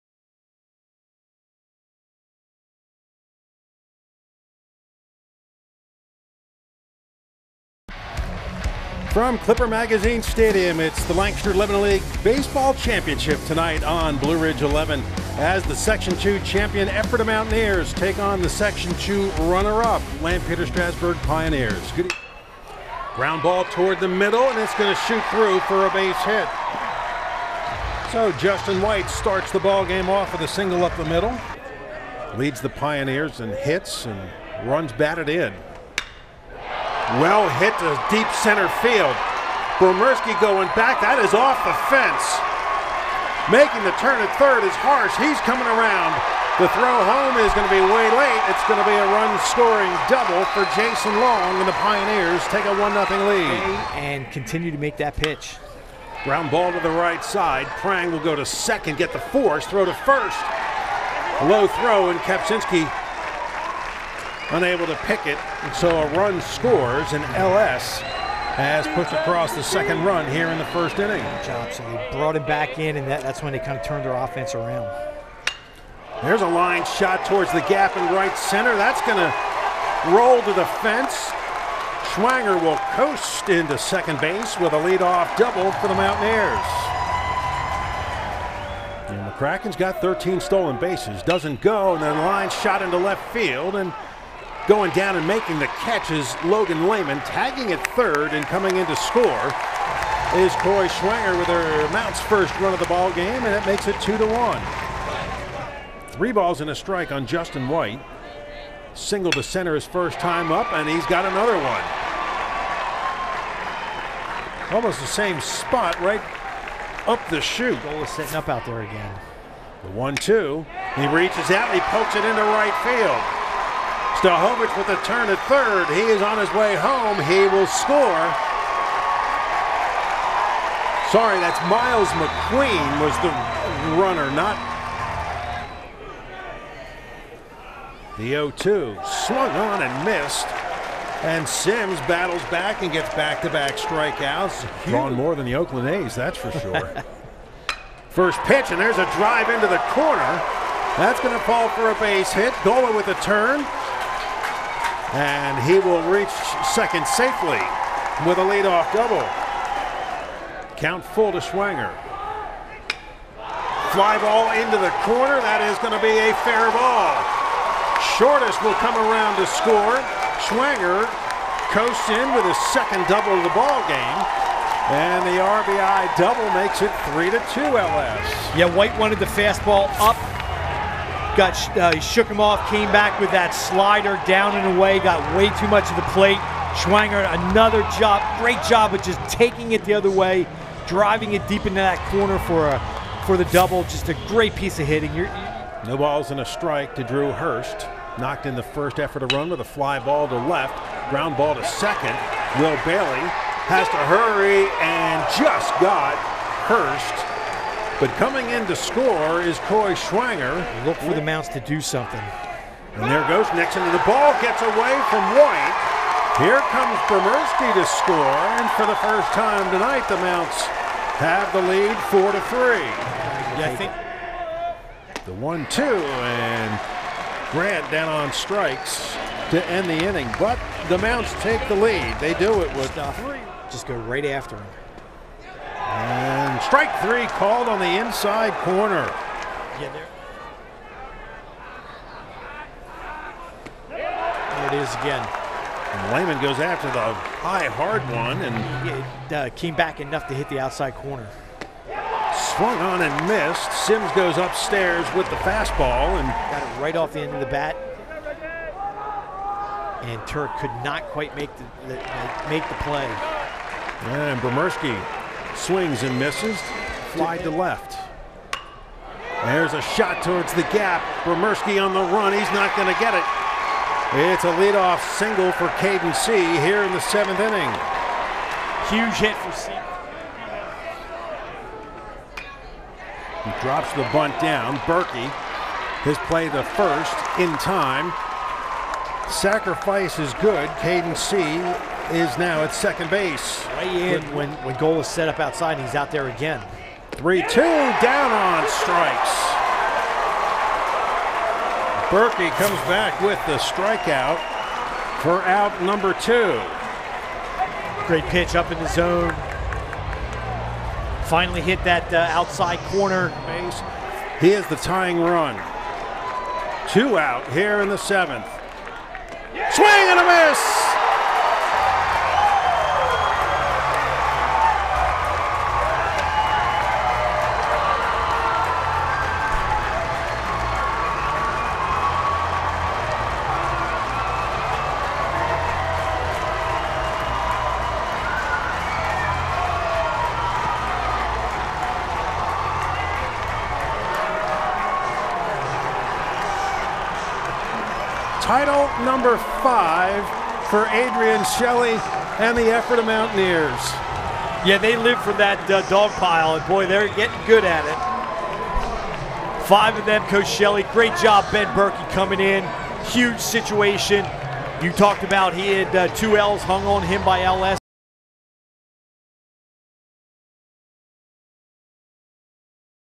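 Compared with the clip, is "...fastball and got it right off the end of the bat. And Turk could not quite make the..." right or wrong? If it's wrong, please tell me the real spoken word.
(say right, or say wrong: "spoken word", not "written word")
right.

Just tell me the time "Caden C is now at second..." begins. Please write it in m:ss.
4:50.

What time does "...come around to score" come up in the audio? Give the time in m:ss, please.
2:48.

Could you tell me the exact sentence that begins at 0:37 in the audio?
Well hit to deep center field.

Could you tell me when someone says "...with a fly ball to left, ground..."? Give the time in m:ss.
3:19.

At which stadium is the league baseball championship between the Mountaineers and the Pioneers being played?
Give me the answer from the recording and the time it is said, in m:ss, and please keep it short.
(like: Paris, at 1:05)
Clipper Magazine Stadium, at 0:09.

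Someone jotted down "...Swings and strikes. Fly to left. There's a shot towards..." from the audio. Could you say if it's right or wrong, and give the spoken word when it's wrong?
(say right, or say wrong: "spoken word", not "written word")
wrong: "misses", not "strikes".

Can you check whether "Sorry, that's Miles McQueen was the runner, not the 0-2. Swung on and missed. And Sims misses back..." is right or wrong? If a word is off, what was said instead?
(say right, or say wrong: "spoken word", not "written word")
wrong: "battles", not "misses".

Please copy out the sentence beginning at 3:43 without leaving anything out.
Yeah, I think the one-two and Grant down on strikes to end the inning, but the Mounts take the lead.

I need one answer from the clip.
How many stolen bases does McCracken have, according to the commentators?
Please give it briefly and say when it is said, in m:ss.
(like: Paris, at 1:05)
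13, at 1:30.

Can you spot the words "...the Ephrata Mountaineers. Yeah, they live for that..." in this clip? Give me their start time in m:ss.
5:52.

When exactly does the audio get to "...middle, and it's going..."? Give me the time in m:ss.
0:24.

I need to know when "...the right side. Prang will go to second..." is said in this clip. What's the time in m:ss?
0:56.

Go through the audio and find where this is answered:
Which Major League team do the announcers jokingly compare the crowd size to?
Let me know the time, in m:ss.
2:25.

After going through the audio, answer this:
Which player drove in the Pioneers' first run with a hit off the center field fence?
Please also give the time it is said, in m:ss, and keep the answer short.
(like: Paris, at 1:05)
Jason Long, at 0:50.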